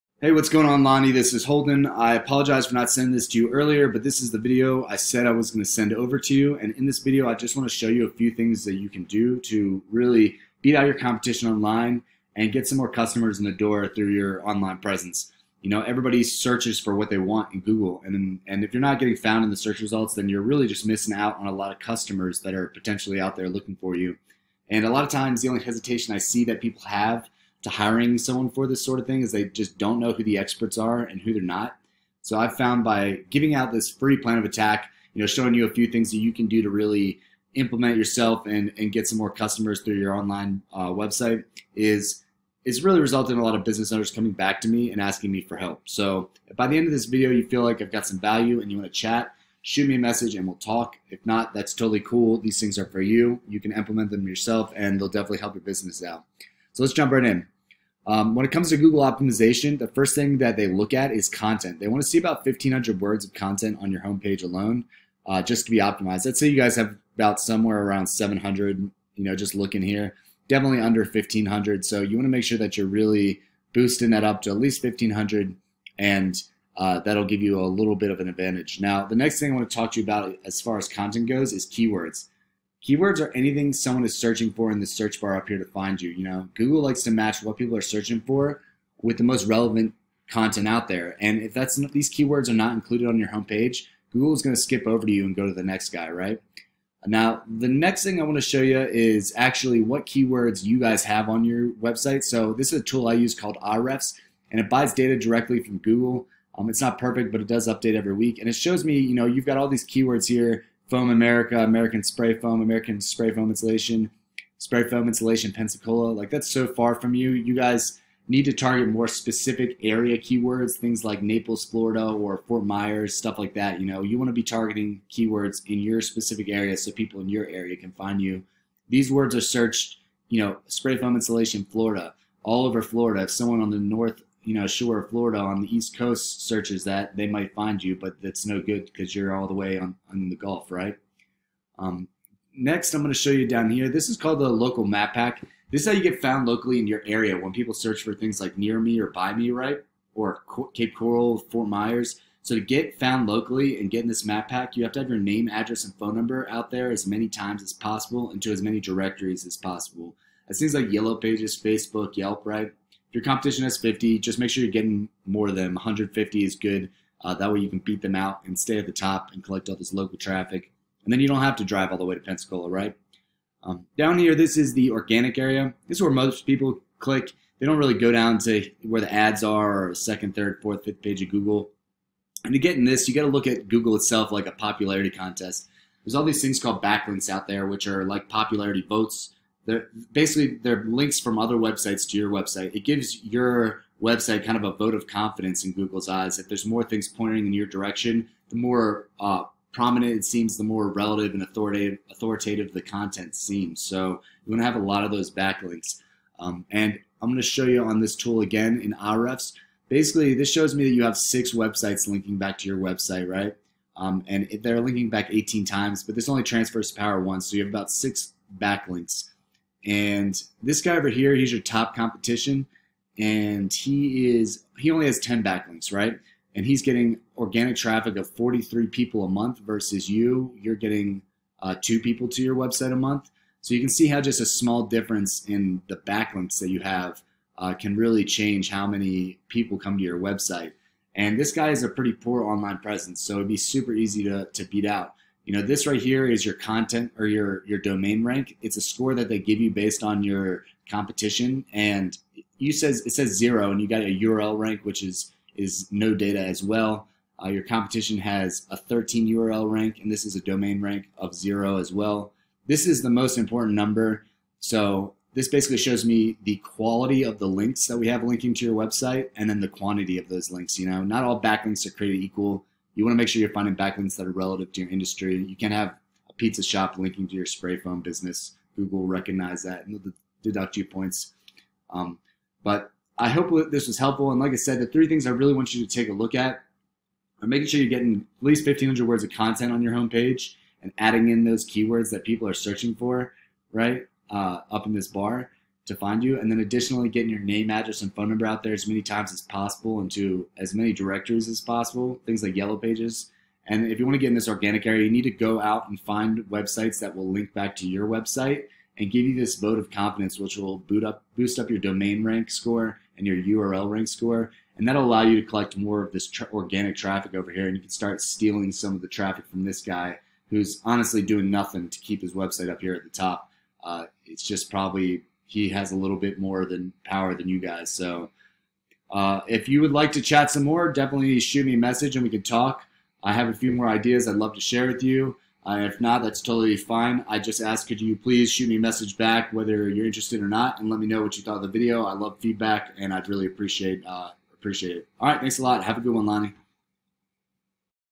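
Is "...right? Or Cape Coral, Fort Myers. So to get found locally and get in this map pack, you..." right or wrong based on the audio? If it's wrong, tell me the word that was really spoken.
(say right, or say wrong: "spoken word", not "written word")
right.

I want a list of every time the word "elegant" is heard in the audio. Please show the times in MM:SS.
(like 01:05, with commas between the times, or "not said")
not said.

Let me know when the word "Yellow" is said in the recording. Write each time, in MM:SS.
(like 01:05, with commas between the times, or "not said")
02:40, 05:02.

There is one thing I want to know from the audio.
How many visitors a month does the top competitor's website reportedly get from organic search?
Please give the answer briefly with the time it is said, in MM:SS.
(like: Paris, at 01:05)
43, at 03:48.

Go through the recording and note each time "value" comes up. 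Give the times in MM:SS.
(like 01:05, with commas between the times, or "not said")
00:48.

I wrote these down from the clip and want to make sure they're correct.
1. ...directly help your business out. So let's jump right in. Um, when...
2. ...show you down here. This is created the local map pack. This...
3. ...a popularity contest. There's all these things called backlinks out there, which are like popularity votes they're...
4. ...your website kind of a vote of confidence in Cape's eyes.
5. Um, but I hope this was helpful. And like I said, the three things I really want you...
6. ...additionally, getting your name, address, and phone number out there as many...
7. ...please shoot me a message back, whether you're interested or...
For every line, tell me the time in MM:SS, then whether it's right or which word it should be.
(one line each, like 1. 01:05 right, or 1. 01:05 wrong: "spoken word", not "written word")
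1. 00:55 wrong: "definitely", not "directly"
2. 02:23 wrong: "called", not "created"
3. 03:04 right
4. 03:13 wrong: "Google", not "Cape"
5. 04:41 right
6. 04:56 right
7. 05:38 right.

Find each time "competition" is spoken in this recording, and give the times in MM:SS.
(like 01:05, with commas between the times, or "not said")
00:10, 02:43, 03:41, 04:10, 04:17.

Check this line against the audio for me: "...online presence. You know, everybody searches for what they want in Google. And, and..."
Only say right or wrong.
right.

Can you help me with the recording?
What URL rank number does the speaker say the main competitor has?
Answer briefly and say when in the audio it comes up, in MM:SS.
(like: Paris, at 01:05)
13, at 04:18.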